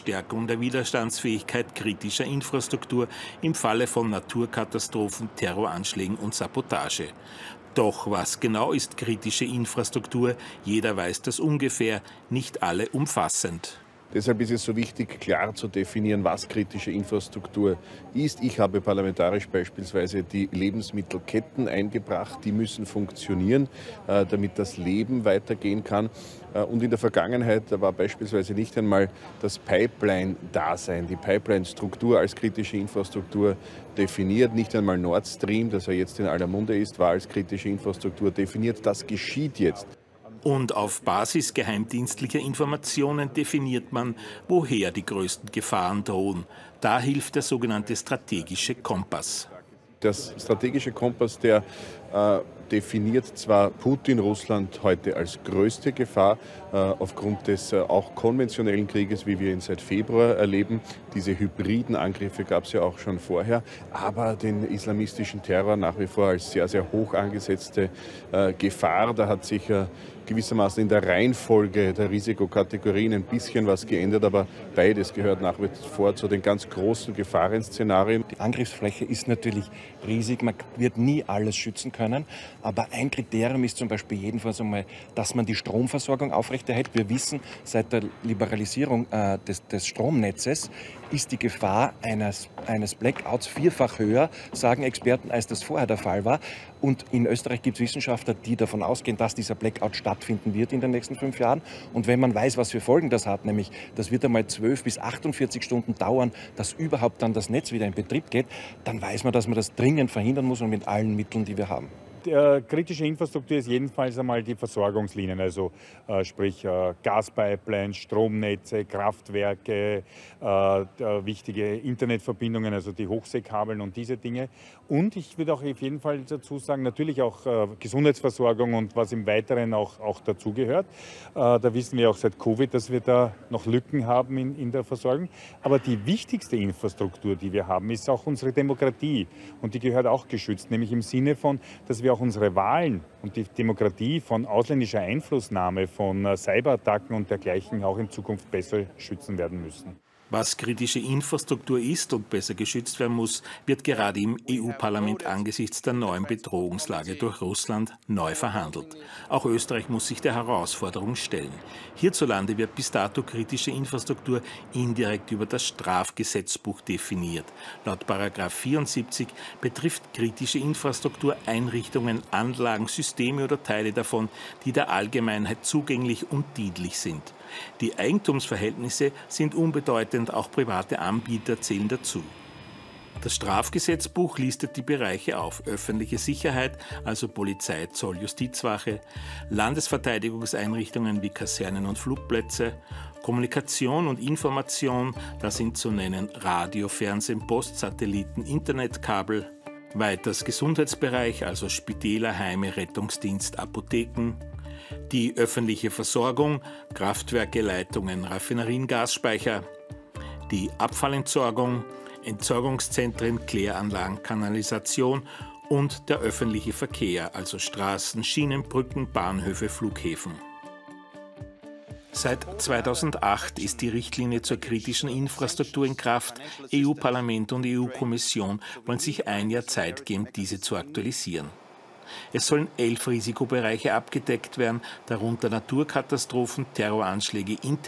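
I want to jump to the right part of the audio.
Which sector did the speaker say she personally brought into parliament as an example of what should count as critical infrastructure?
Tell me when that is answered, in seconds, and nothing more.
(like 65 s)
20 s.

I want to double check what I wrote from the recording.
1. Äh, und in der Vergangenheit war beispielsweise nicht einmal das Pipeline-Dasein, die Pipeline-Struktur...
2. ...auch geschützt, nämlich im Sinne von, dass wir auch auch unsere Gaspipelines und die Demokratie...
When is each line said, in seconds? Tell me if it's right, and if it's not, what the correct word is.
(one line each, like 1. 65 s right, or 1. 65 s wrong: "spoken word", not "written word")
1. 26 s right
2. 140 s wrong: "Wahlen", not "Gaspipelines".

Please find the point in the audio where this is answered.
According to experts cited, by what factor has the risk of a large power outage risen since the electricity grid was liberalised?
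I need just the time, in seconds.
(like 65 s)
93 s.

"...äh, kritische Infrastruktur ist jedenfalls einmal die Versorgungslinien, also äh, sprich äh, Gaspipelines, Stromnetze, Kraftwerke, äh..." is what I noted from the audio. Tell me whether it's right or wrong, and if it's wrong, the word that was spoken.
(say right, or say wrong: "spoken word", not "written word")
right.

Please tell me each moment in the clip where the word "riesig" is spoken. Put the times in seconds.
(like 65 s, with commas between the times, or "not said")
80 s.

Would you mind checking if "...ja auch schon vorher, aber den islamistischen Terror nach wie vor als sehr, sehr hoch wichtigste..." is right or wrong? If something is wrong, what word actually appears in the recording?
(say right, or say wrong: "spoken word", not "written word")
wrong: "angesetzte", not "wichtigste".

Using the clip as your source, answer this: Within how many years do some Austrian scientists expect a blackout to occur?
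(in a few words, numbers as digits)
5.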